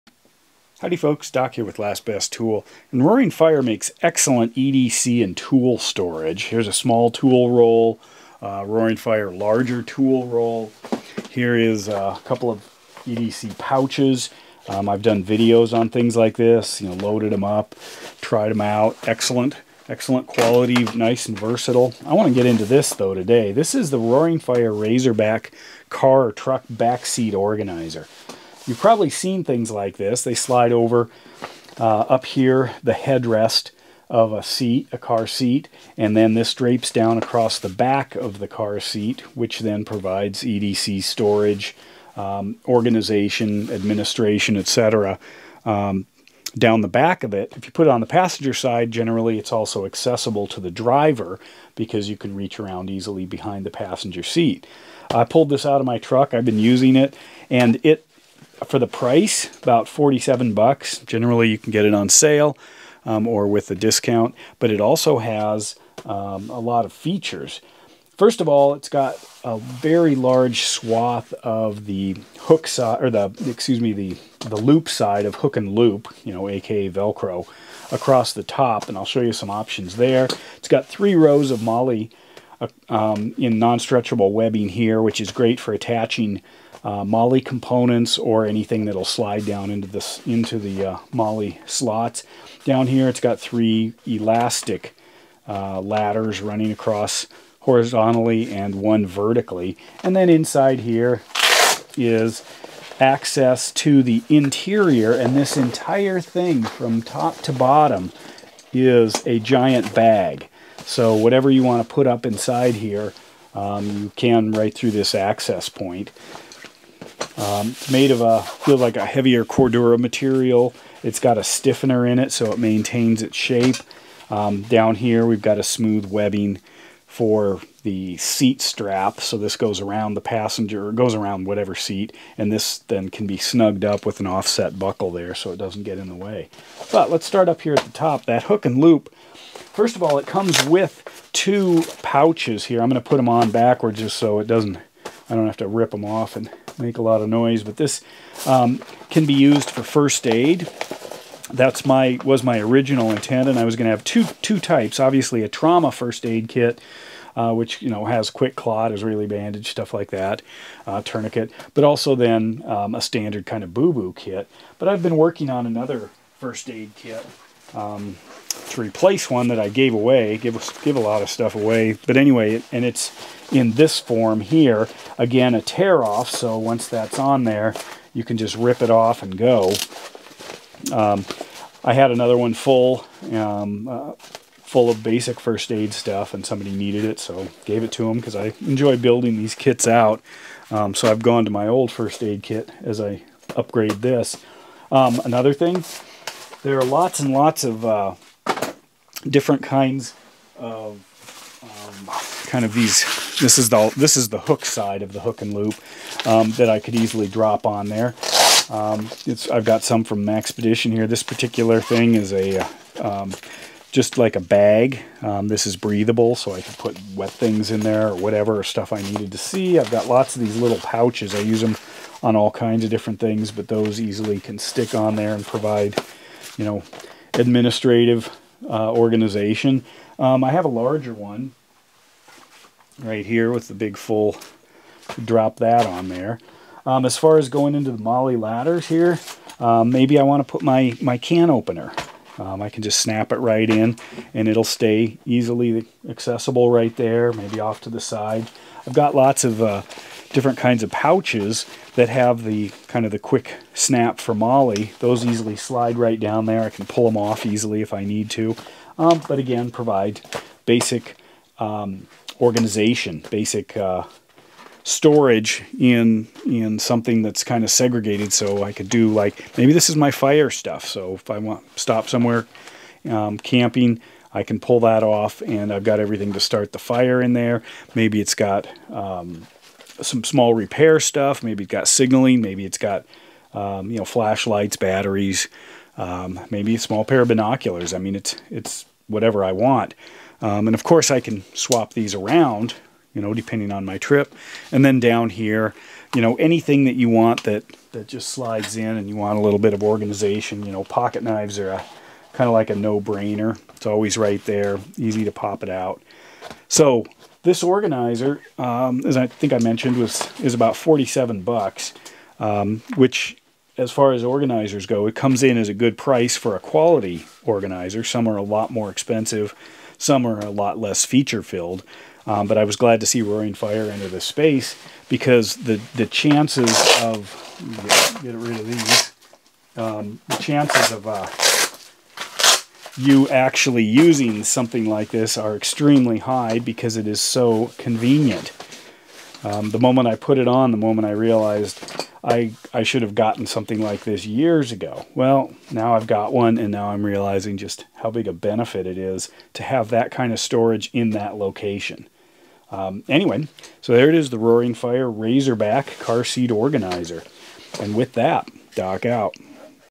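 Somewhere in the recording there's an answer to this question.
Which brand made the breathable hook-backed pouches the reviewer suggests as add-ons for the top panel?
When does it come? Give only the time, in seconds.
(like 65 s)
210 s.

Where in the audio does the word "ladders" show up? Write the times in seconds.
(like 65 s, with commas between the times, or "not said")
95 s, 238 s.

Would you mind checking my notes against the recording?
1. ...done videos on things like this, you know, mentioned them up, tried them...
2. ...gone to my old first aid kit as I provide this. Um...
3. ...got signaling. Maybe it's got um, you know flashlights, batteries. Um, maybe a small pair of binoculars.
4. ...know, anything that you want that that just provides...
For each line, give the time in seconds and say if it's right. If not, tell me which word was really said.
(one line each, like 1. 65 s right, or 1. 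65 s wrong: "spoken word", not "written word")
1. 15 s wrong: "loaded", not "mentioned"
2. 191 s wrong: "upgrade", not "provide"
3. 281 s right
4. 296 s wrong: "slides", not "provides".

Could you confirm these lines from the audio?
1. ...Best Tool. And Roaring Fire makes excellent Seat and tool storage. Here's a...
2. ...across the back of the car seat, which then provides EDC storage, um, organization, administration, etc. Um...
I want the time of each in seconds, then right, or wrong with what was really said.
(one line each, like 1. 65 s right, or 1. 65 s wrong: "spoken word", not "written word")
1. 2 s wrong: "EDC", not "Seat"
2. 37 s right.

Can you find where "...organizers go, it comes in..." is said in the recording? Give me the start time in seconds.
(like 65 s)
314 s.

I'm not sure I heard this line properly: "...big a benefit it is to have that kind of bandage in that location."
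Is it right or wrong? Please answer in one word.
wrong.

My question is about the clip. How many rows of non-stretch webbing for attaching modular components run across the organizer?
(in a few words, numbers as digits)
3.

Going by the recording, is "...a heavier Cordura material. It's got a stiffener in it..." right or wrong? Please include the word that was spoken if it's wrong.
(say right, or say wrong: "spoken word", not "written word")
right.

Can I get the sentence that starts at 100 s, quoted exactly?
And then inside here is access to the interior and this entire thing from top to bottom is a giant bag.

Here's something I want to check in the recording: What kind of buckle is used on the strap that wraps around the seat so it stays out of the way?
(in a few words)
offset buckle.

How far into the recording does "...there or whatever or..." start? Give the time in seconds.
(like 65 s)
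217 s.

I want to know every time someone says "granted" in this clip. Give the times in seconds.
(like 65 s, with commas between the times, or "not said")
not said.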